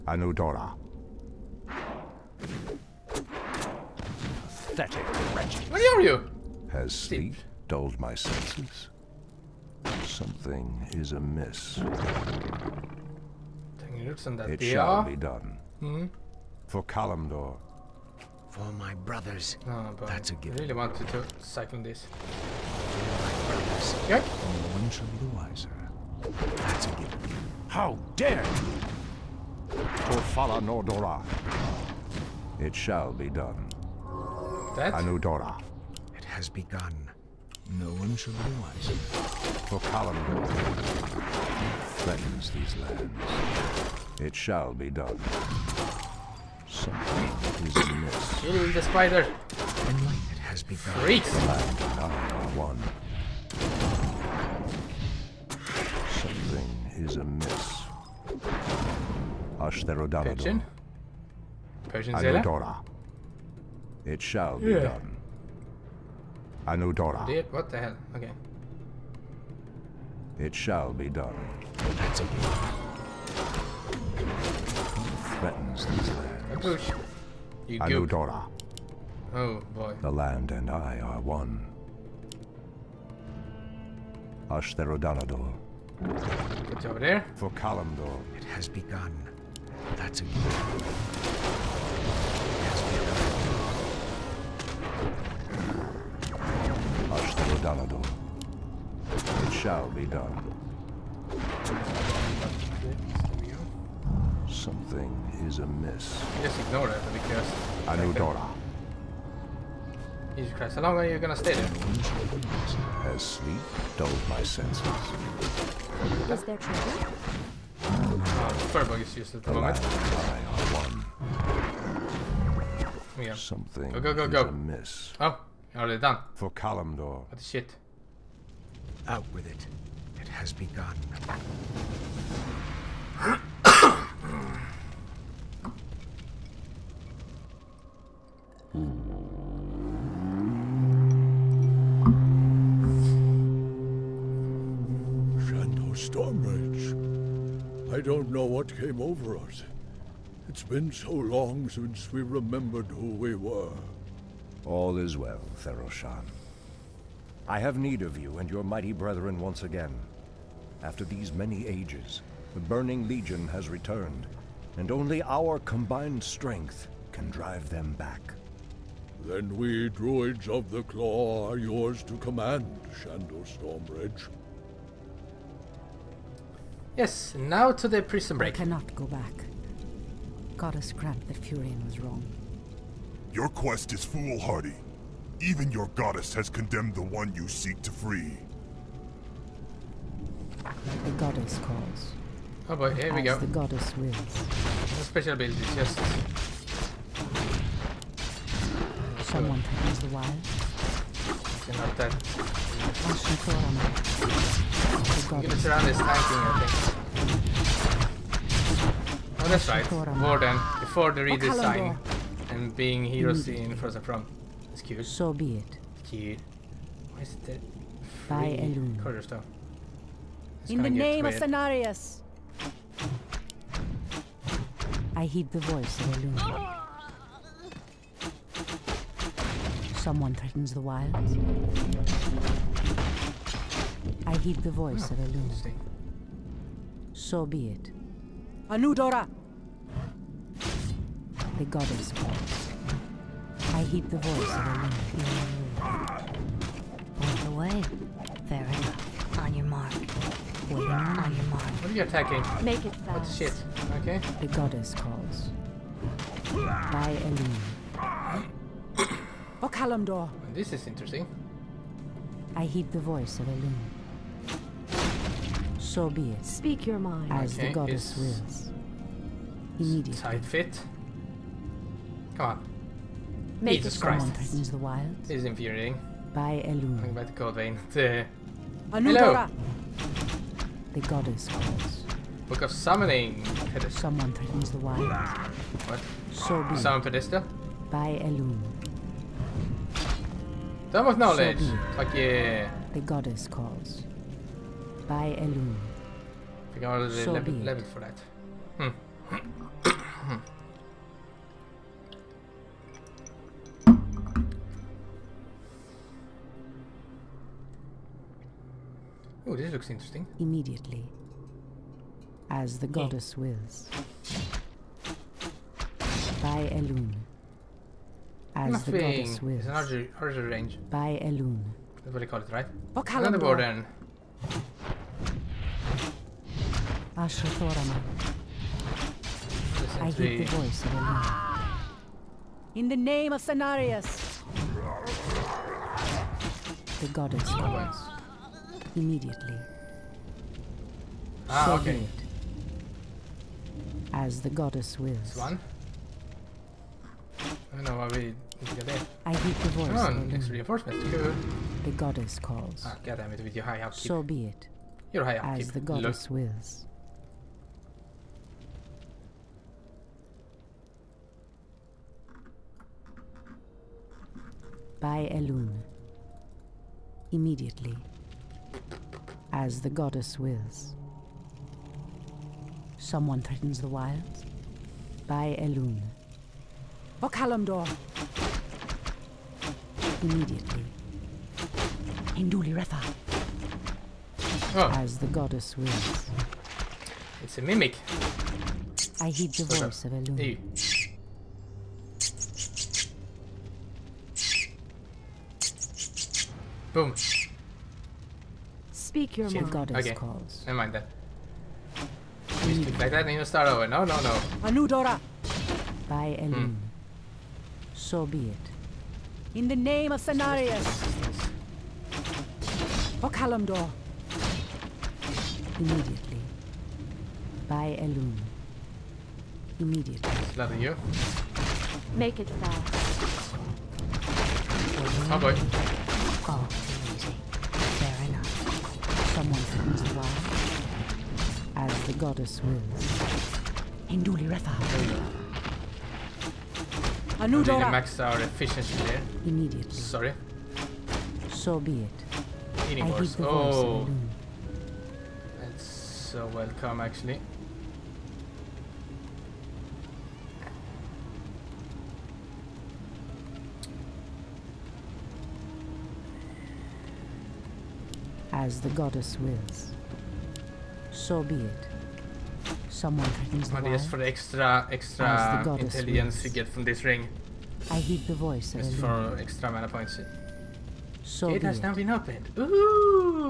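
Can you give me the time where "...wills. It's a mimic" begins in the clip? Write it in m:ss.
6:25.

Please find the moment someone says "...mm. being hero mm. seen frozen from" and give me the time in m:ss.
3:32.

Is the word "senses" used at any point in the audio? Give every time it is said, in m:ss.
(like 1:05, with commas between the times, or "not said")
0:08, 1:54.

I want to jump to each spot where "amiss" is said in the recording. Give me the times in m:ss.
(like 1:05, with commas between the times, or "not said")
0:11, 0:47, 0:57, 1:45, 2:04.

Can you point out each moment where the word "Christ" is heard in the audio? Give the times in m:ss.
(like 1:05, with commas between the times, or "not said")
1:50, 4:33.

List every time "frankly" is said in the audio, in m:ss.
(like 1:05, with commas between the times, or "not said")
not said.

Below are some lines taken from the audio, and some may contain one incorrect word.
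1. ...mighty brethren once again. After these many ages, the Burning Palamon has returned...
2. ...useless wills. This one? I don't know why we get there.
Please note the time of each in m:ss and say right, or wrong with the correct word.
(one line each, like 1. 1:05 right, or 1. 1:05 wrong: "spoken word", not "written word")
1. 2:38 wrong: "Legion", not "Palamon"
2. 5:44 wrong: "goddess", not "useless".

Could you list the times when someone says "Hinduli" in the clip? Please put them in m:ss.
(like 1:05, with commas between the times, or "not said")
6:22, 7:14.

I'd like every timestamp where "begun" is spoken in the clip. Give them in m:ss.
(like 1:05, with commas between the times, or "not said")
0:36, 0:50, 1:28, 1:32, 2:10.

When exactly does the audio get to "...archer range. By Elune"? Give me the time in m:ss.
5:20.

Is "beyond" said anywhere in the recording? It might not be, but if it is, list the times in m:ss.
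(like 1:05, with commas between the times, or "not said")
4:07.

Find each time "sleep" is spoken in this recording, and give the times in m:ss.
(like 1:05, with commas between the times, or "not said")
0:06, 1:53.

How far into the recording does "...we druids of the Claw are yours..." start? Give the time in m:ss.
2:49.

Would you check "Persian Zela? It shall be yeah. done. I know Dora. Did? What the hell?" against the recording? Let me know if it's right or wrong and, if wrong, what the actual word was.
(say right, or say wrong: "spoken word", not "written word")
right.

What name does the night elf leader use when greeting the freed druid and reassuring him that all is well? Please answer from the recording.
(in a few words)
Theroshan.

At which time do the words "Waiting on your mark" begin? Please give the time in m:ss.
4:10.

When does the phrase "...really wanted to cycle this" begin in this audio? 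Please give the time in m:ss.
0:20.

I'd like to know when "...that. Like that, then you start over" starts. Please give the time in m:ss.
6:40.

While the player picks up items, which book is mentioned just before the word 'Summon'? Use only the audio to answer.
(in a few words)
Book of Summoning.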